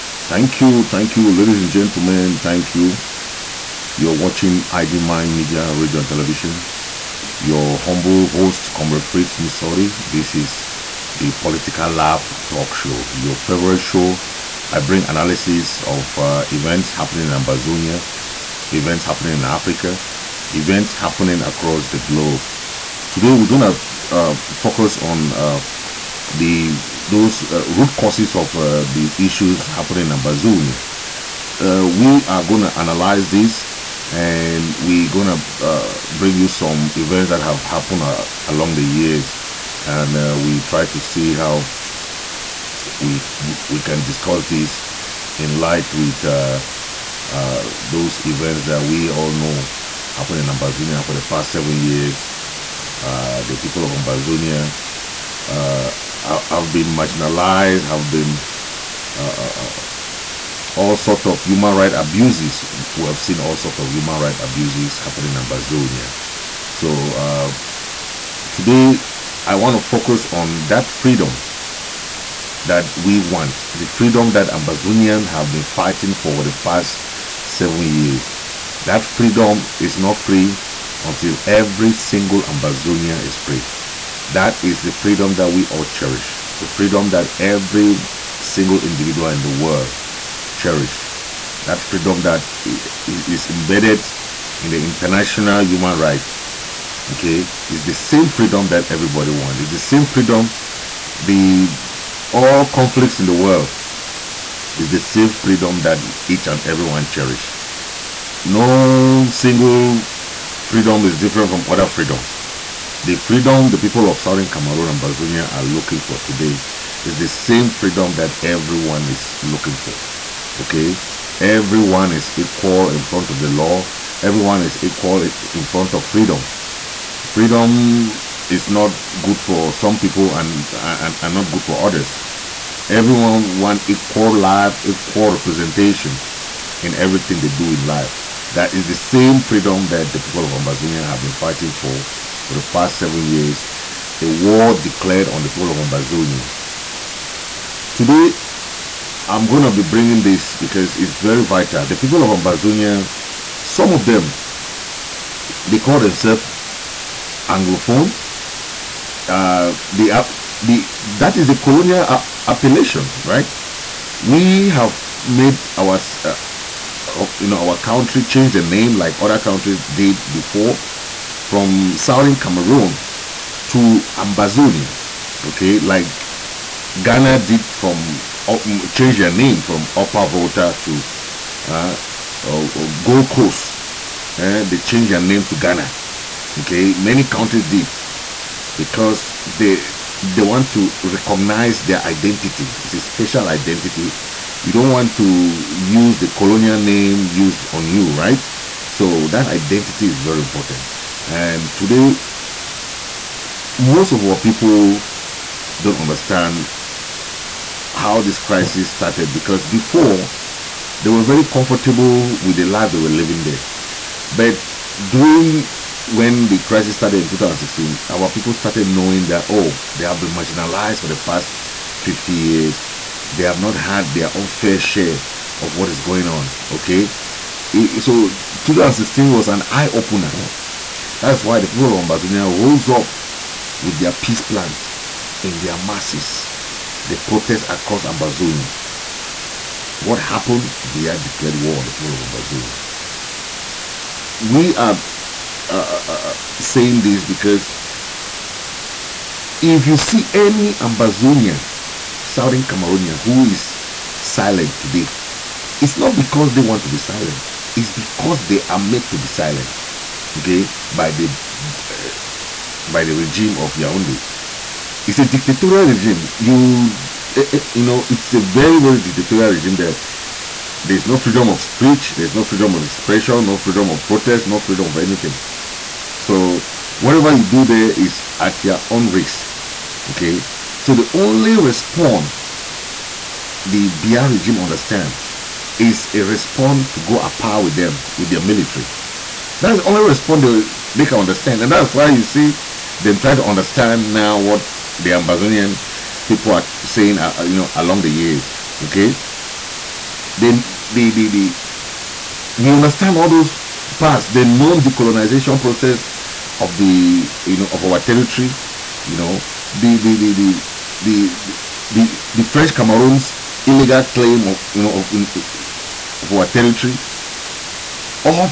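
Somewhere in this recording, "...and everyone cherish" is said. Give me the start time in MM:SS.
01:46.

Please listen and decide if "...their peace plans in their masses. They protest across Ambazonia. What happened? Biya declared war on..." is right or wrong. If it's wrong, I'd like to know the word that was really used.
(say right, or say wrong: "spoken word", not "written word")
right.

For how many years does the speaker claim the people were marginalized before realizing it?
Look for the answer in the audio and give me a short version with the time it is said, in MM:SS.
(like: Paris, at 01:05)
50, at 03:41.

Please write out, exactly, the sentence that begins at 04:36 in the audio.
So whatever you do there is at your own risk.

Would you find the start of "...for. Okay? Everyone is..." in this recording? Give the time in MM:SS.
01:59.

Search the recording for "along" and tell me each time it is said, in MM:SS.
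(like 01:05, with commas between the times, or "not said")
00:38, 04:57.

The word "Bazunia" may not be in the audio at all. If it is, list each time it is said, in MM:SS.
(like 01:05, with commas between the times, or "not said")
00:30, 01:55.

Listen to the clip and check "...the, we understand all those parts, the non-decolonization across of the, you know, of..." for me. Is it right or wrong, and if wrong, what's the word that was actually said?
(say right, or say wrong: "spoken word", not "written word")
wrong: "process", not "across".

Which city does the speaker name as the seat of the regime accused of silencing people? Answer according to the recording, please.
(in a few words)
Yaoundé.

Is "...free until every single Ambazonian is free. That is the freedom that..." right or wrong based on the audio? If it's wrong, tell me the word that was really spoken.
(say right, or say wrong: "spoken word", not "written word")
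right.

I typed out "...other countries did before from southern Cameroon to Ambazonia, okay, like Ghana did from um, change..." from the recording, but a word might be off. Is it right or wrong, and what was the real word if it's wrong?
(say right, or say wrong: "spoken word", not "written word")
right.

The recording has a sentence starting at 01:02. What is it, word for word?
We have seen all sort of human right abuses happening in Ambazonia.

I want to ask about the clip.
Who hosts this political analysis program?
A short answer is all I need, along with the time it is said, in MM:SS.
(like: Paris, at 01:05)
Fritz Misodi, at 00:09.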